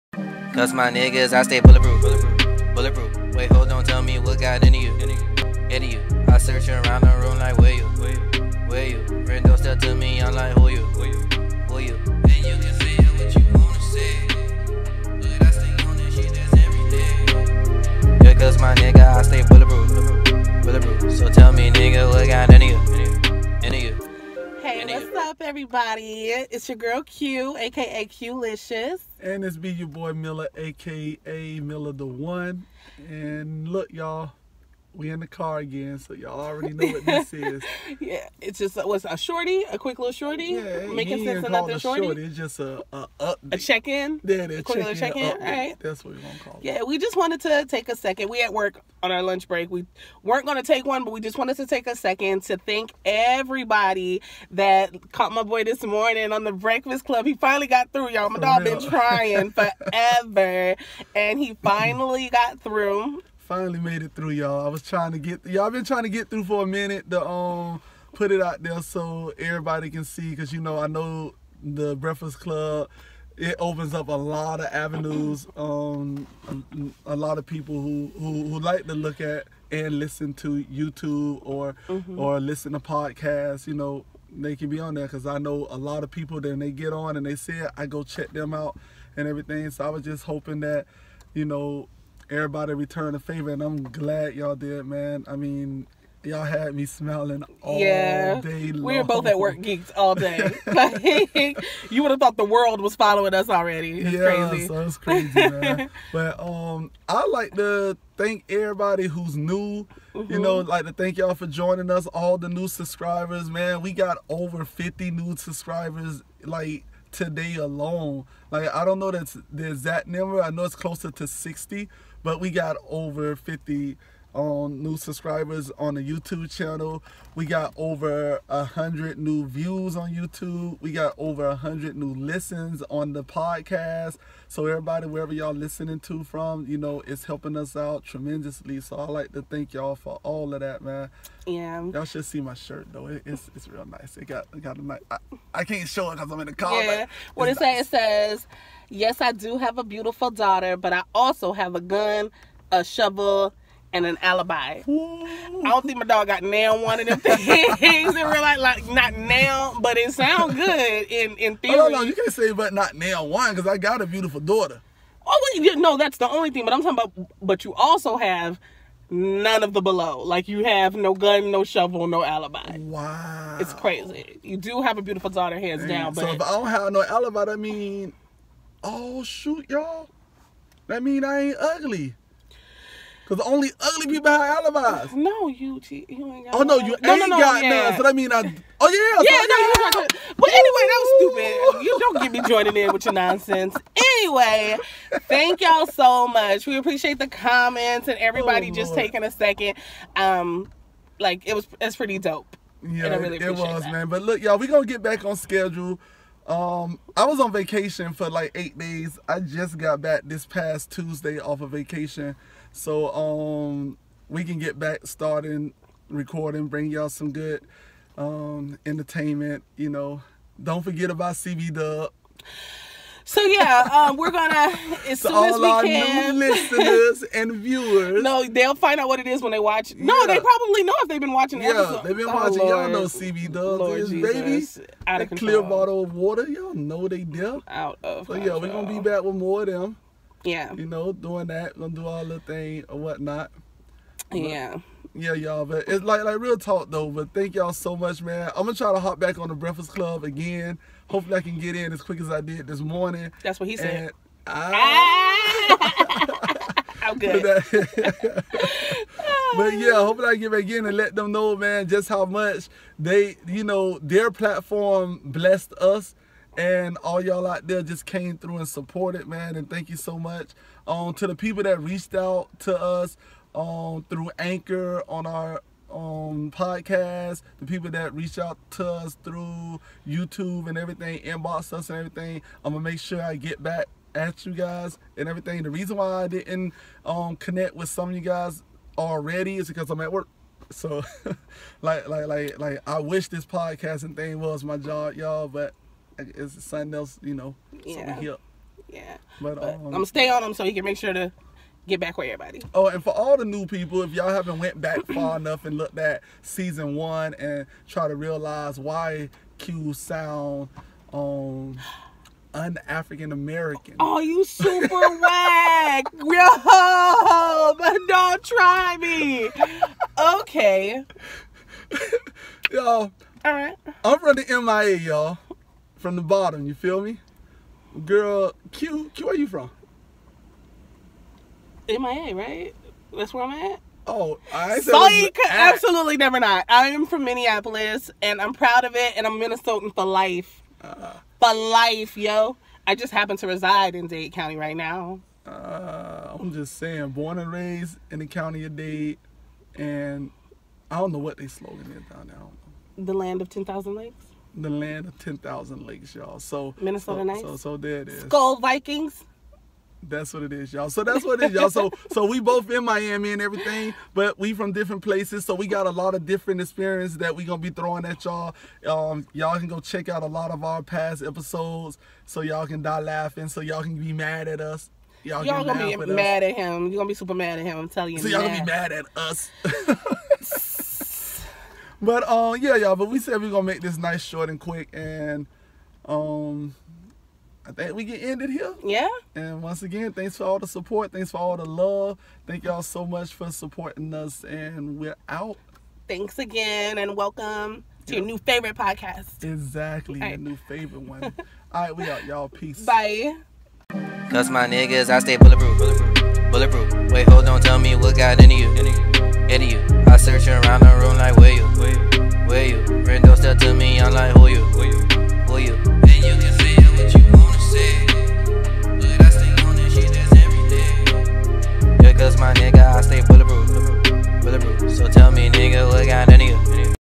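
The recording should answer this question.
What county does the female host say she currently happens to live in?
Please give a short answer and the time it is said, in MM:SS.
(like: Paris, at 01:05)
Dade County, at 05:44.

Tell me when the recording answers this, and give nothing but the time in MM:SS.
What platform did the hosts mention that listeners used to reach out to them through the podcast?
04:34.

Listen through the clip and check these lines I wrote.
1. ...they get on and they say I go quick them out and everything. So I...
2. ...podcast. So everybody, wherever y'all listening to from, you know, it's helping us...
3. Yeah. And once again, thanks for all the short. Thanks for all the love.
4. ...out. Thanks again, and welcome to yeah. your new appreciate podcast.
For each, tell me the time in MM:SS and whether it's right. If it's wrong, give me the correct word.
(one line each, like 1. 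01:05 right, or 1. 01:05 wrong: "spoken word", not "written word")
1. 01:26 wrong: "check", not "quick"
2. 02:13 right
3. 06:28 wrong: "support", not "short"
4. 06:35 wrong: "favorite", not "appreciate".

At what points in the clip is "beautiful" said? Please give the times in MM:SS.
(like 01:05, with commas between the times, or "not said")
02:29, 02:44, 02:55.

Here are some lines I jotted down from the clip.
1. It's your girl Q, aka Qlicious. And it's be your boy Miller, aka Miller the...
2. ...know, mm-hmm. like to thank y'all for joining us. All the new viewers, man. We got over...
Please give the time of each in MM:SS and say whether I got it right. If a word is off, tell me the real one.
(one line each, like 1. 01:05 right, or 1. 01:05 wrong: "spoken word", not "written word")
1. 00:26 right
2. 01:50 wrong: "subscribers", not "viewers".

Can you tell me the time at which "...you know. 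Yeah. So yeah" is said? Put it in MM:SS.
04:57.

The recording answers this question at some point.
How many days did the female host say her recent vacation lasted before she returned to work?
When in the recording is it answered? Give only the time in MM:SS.
03:28.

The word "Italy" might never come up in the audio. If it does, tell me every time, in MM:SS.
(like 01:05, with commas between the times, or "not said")
not said.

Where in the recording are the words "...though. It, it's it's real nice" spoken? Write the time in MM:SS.
02:22.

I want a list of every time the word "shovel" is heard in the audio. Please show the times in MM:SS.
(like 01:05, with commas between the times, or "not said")
02:32, 02:51.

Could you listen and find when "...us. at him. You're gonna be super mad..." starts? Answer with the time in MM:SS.
06:16.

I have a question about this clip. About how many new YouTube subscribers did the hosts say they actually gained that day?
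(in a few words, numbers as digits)
60.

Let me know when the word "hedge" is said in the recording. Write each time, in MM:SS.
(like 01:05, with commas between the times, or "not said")
not said.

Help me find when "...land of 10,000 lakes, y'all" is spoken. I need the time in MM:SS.
05:54.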